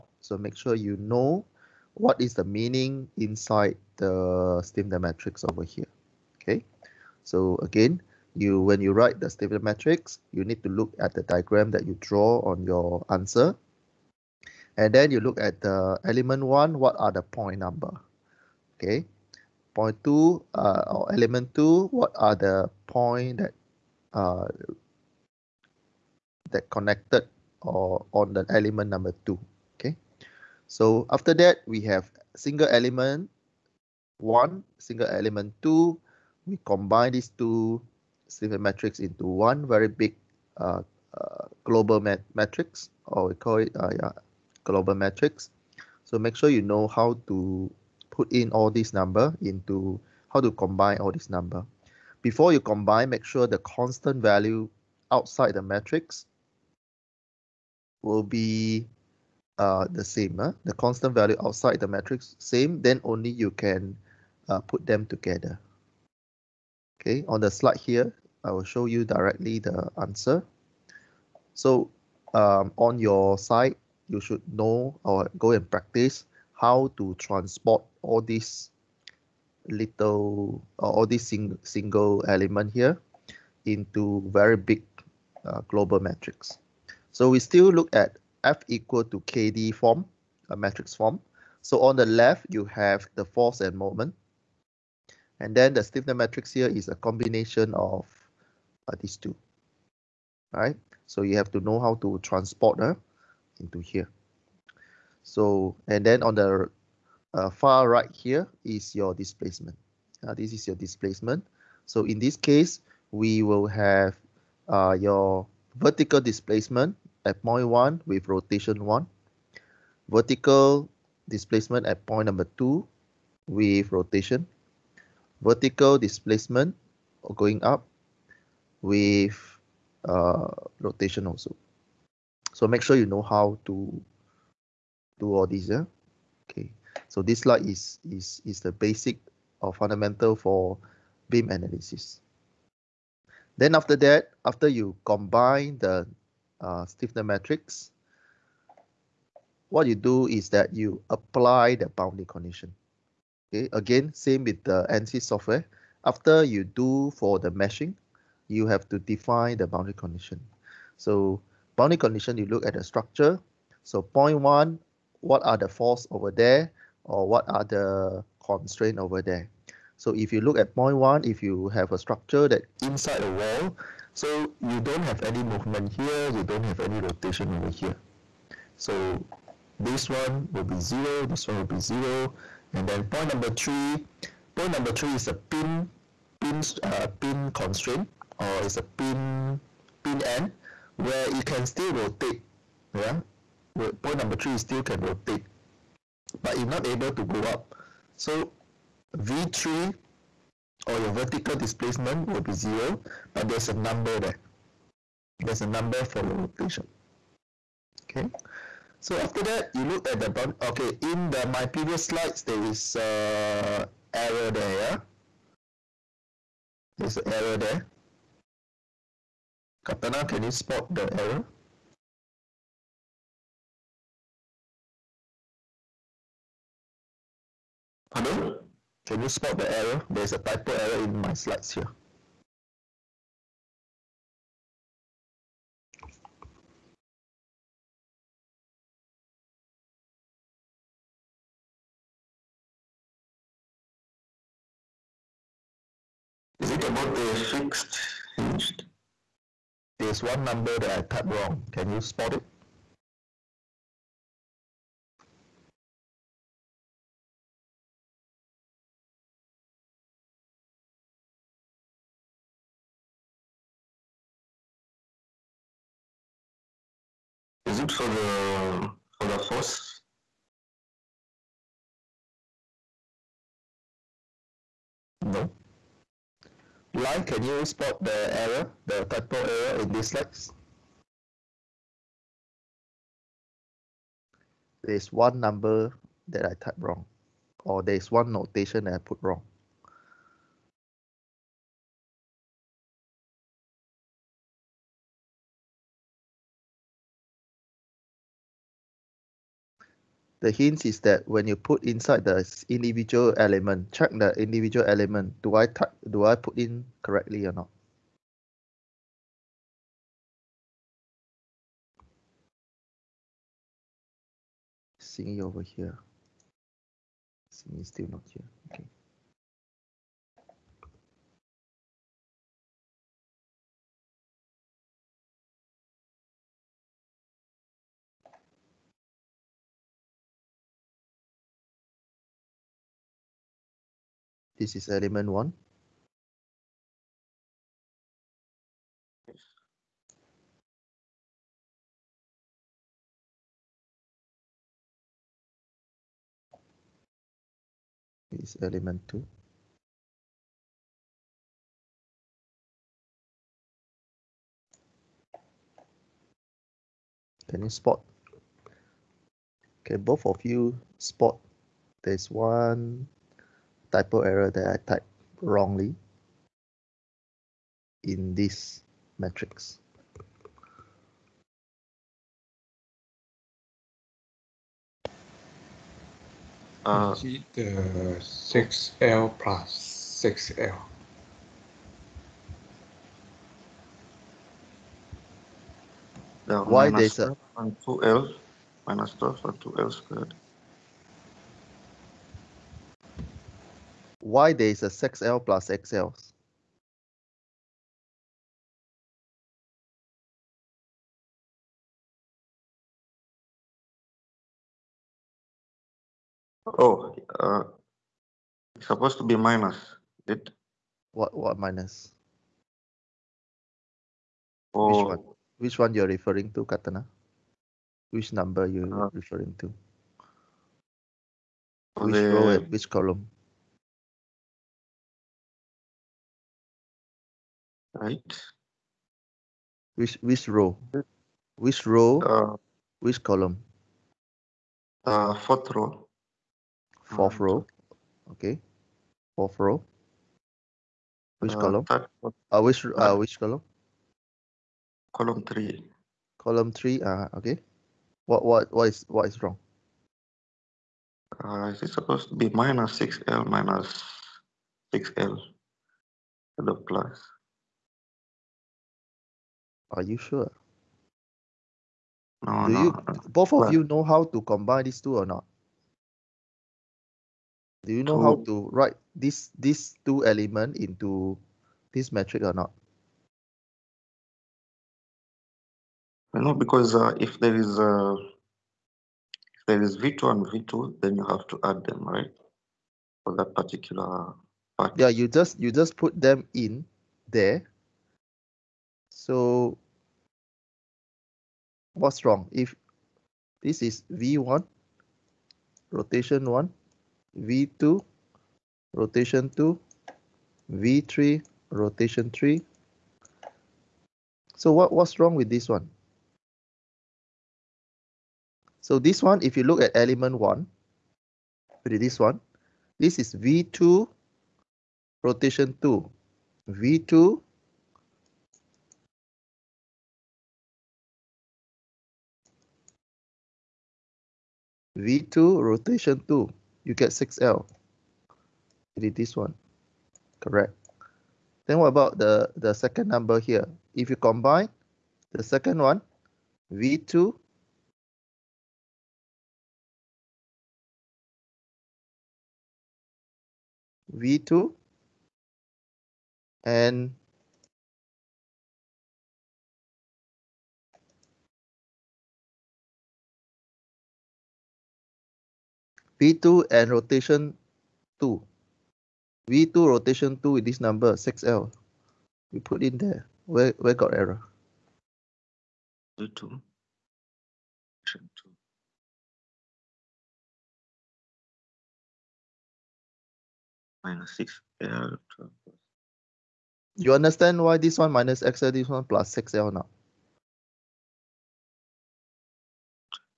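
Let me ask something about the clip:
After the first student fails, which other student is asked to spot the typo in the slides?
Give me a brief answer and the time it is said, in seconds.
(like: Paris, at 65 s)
Lai, at 276 s.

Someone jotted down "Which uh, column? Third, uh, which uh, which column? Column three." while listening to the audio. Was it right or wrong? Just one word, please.
right.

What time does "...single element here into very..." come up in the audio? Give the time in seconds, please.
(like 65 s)
81 s.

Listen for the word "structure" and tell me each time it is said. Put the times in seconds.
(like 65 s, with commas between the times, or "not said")
162 s, 171 s.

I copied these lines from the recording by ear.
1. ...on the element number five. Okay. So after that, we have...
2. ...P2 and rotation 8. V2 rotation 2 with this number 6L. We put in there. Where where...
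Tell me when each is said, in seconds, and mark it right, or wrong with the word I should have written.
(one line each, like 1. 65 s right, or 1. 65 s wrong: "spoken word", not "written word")
1. 28 s wrong: "two", not "five"
2. 556 s wrong: "2", not "8".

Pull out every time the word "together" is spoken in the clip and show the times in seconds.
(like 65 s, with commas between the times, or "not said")
65 s.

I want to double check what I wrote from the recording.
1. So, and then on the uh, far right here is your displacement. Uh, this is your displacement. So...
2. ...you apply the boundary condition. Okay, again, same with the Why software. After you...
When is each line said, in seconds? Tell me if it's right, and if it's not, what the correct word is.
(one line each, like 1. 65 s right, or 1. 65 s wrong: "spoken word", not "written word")
1. 105 s right
2. 150 s wrong: "ANSYS", not "Why".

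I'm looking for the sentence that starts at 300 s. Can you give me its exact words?
the hint is that when you put inside the individual element, check the individual element.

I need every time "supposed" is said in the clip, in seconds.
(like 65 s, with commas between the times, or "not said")
408 s, 451 s.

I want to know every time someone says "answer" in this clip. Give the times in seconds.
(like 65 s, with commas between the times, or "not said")
13 s, 70 s.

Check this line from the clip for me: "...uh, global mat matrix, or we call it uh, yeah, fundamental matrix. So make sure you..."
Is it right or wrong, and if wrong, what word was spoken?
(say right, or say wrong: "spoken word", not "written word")
wrong: "global", not "fundamental".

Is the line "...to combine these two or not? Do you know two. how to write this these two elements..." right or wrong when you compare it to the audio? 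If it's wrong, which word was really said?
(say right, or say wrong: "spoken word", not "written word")
right.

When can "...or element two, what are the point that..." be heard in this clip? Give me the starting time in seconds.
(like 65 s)
20 s.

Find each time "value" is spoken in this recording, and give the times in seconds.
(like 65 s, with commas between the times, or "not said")
54 s, 61 s.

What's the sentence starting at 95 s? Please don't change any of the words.
And then the stiffness matrix here is a combination of uh, these two.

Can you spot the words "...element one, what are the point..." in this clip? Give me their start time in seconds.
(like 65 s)
16 s.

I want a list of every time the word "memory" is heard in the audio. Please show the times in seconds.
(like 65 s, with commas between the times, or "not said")
not said.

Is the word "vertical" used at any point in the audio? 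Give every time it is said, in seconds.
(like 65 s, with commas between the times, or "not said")
115 s, 120 s, 125 s, 201 s.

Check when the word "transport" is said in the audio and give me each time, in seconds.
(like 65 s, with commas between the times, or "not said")
77 s, 102 s.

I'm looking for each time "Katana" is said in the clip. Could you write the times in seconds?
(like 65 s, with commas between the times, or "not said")
219 s, 416 s.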